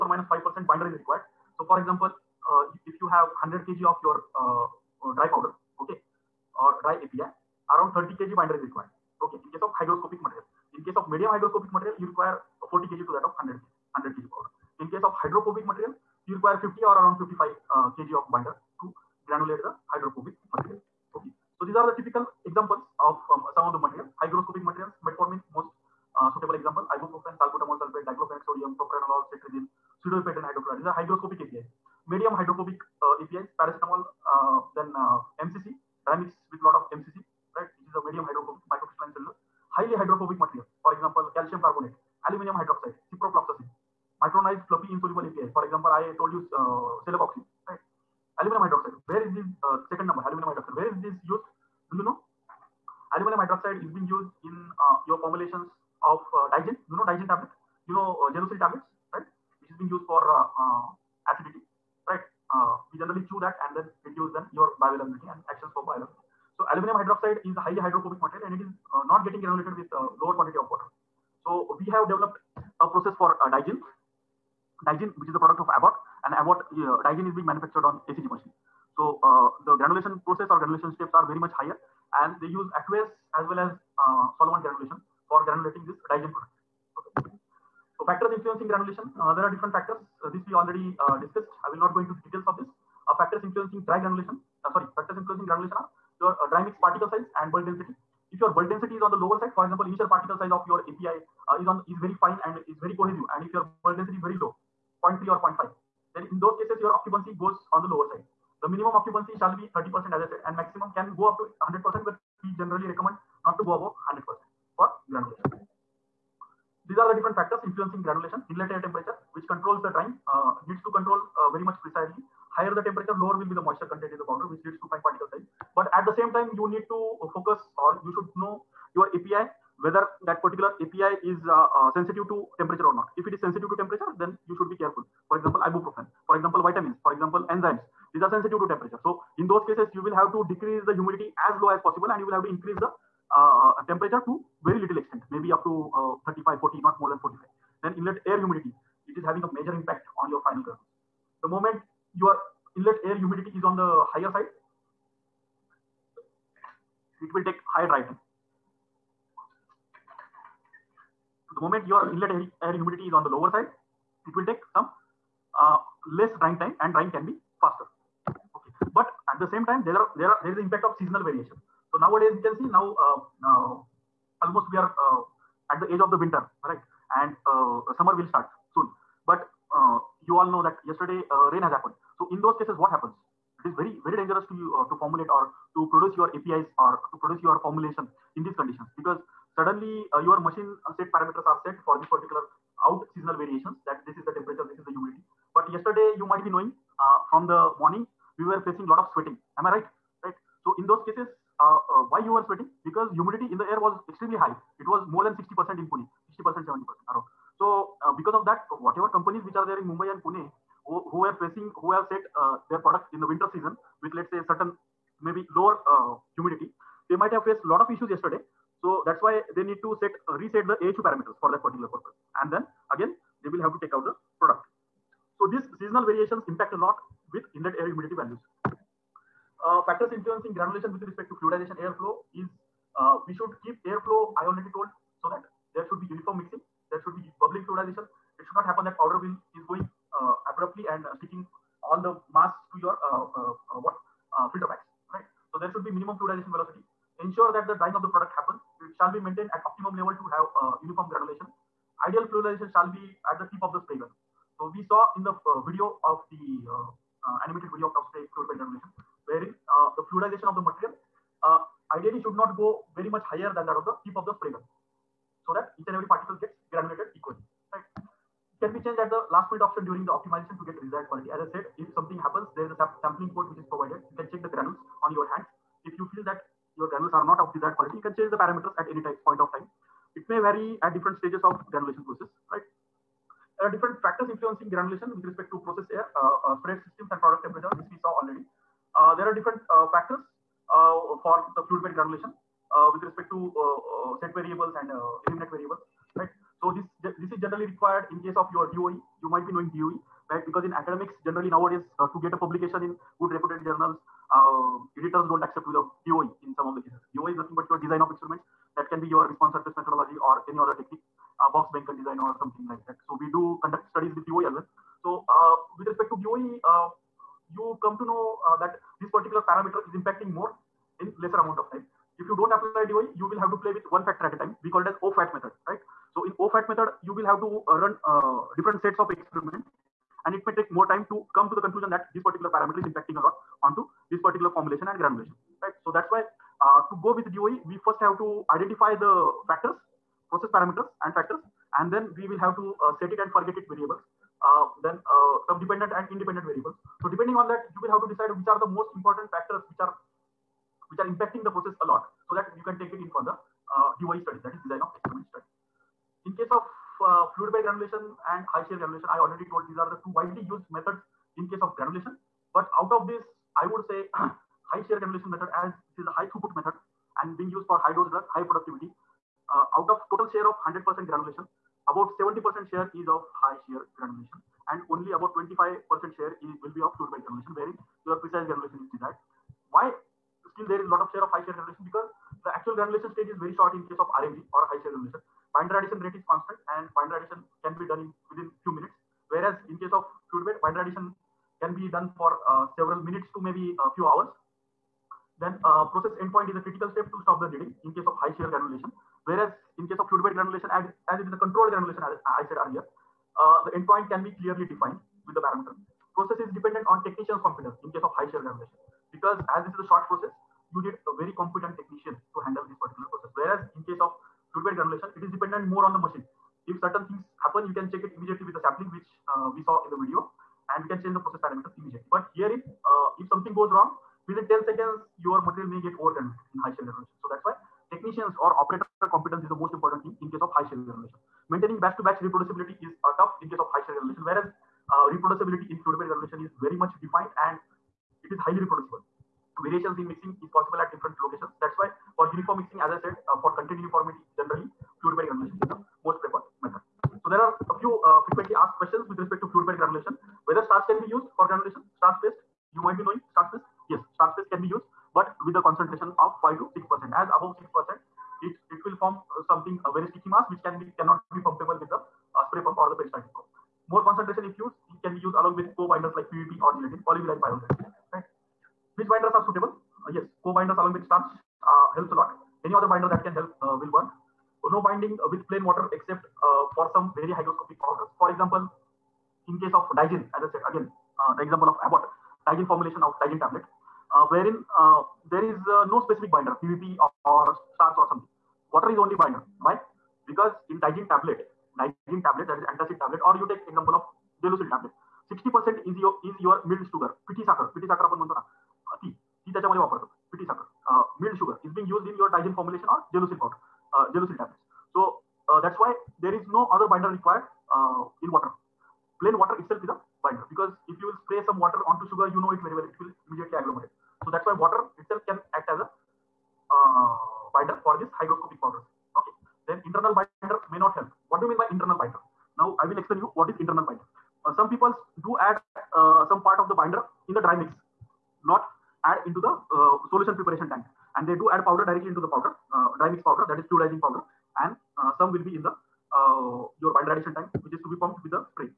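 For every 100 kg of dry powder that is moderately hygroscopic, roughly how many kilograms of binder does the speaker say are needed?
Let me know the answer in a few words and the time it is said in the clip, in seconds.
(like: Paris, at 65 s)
40 kg, at 12 s.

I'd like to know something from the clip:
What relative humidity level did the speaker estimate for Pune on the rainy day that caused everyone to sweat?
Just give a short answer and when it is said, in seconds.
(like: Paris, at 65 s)
60% to 70%, at 206 s.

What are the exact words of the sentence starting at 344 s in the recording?
Uh, then uh, some dependent and independent variables.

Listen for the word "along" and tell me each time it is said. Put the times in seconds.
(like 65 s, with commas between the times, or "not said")
465 s, 470 s.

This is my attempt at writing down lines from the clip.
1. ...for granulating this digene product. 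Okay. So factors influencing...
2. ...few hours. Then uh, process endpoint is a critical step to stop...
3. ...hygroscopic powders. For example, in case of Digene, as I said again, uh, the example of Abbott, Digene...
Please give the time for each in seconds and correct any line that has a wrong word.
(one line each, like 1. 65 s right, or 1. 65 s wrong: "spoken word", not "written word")
1. 85 s right
2. 393 s right
3. 477 s right.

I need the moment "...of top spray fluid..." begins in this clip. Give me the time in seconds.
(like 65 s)
257 s.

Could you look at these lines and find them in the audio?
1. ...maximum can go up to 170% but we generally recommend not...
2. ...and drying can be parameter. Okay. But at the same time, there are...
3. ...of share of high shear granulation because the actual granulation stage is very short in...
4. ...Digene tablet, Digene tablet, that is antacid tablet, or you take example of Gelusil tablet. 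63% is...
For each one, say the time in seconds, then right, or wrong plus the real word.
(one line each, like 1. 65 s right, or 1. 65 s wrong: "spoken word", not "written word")
1. 110 s wrong: "100", not "170"
2. 166 s wrong: "faster", not "parameter"
3. 381 s right
4. 490 s wrong: "60", not "63".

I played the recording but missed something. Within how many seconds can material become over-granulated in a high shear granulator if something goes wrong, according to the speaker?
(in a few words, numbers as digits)
10 seconds.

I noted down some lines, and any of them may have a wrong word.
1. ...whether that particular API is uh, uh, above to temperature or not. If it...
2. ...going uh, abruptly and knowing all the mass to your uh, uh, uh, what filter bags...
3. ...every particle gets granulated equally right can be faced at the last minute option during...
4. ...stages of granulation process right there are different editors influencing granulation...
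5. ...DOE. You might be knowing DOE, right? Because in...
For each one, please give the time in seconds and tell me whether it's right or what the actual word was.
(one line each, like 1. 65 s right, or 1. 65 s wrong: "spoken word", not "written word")
1. 129 s wrong: "sensitive", not "above"
2. 239 s wrong: "sticking", not "knowing"
3. 265 s wrong: "changed", not "faced"
4. 281 s wrong: "factors", not "editors"
5. 298 s right.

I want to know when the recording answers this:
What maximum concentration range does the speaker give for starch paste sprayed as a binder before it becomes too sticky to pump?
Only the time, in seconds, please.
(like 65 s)
456 s.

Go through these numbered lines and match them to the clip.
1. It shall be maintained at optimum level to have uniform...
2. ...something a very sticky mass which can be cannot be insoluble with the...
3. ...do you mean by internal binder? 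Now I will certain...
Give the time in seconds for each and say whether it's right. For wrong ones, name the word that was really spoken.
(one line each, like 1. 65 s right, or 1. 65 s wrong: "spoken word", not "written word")
1. 248 s right
2. 459 s wrong: "pumpable", not "insoluble"
3. 521 s wrong: "explain", not "certain".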